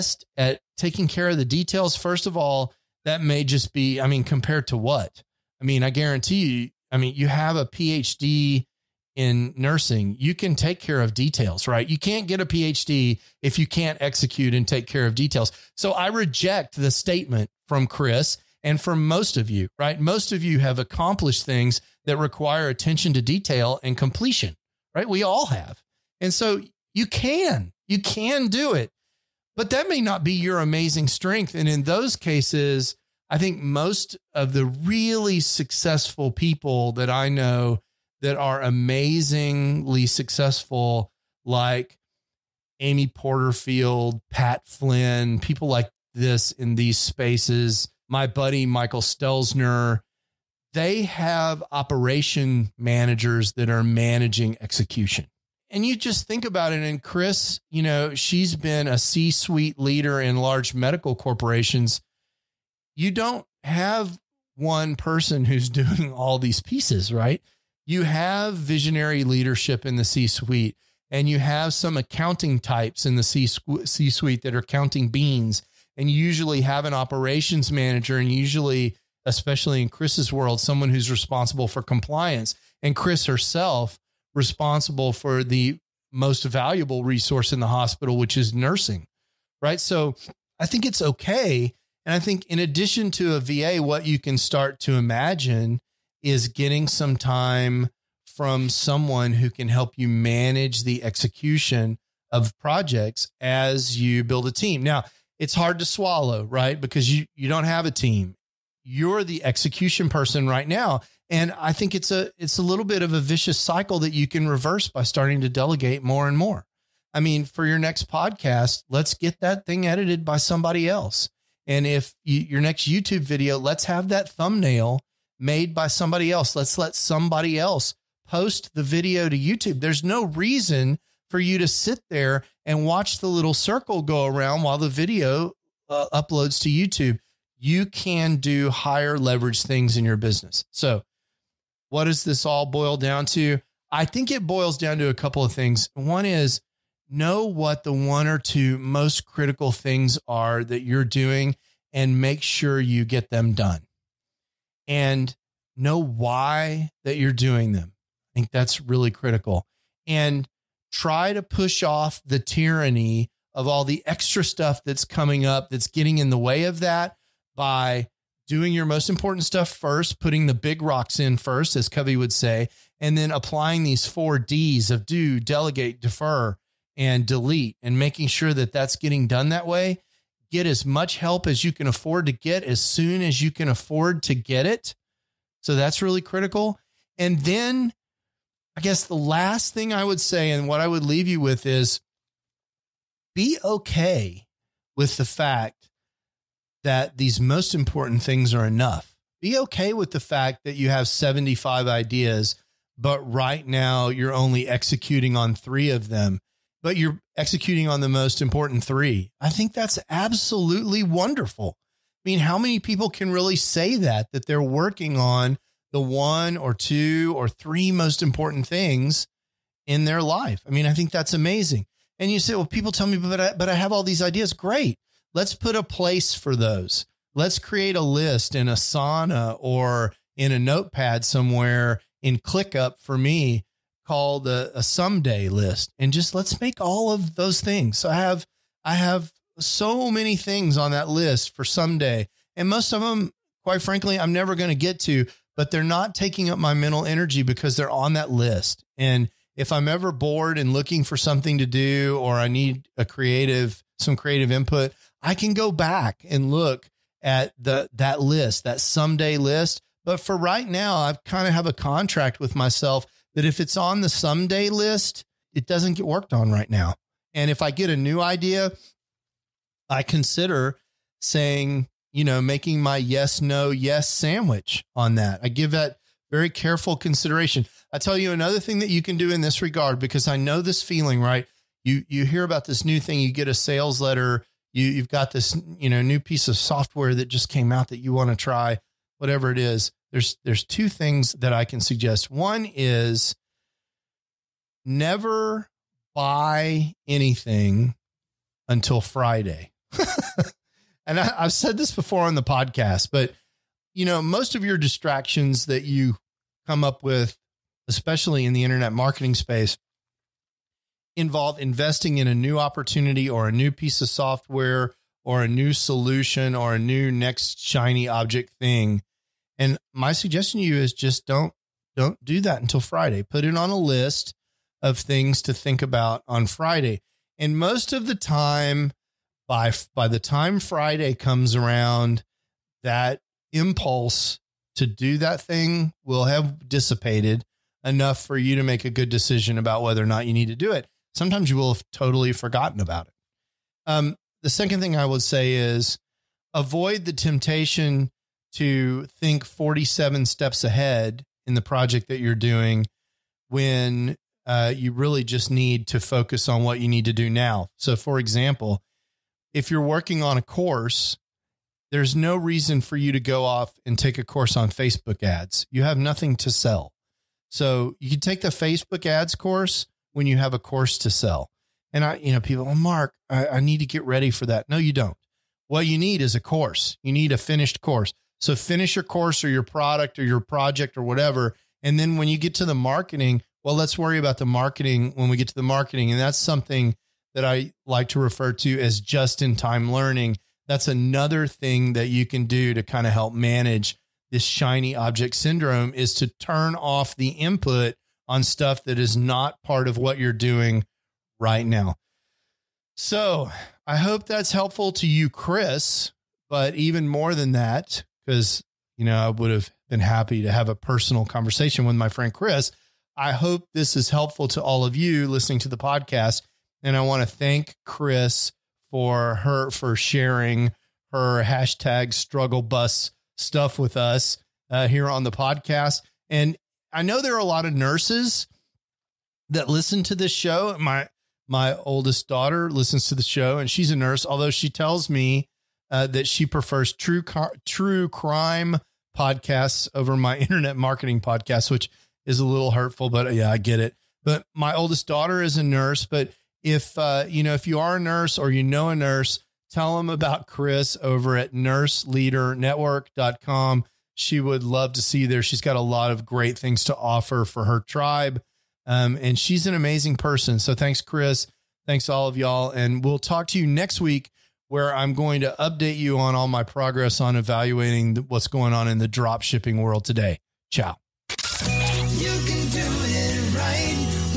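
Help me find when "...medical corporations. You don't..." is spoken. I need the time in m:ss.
1:00.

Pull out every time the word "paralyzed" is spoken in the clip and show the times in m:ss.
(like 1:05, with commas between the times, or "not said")
not said.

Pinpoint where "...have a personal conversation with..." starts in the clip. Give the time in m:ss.
6:50.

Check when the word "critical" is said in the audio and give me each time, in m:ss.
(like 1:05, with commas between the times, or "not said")
2:29, 2:39, 3:06.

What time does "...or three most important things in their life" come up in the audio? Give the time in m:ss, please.
3:37.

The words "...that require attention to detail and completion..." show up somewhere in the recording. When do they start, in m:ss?
0:22.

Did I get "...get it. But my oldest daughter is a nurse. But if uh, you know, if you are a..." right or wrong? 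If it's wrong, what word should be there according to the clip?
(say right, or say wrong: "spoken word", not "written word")
right.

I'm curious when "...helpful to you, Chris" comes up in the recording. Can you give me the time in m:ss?
6:44.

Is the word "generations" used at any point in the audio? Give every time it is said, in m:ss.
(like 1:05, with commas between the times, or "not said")
not said.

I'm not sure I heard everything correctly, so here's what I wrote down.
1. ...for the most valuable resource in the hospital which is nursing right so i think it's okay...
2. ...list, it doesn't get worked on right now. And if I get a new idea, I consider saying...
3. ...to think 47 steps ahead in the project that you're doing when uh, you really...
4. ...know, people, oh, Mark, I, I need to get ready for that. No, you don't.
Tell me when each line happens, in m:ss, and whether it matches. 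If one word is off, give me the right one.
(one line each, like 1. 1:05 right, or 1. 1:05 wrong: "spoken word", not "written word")
1. 1:25 right
2. 4:24 right
3. 5:48 right
4. 6:12 right.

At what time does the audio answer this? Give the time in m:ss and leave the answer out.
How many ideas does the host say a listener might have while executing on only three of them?
3:21.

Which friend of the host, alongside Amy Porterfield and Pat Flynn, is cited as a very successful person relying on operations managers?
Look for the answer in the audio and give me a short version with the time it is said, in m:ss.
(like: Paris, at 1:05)
Michael Stelzner, at 0:48.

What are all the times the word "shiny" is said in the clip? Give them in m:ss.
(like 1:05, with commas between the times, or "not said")
5:17, 6:34.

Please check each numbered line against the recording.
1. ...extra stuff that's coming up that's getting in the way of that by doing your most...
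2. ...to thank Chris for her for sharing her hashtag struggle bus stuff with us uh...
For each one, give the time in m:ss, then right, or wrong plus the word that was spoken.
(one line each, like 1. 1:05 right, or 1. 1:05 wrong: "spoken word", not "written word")
1. 2:44 right
2. 6:57 right.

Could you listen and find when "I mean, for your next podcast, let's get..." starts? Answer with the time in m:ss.
1:57.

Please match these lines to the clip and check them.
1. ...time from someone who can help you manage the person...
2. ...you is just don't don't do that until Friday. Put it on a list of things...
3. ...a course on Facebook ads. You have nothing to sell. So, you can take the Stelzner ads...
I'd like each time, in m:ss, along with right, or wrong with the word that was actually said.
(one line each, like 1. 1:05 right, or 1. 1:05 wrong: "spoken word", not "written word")
1. 1:37 wrong: "execution", not "person"
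2. 5:20 right
3. 6:04 wrong: "Facebook", not "Stelzner".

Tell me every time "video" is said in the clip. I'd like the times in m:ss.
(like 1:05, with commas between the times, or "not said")
2:03, 2:08, 2:14.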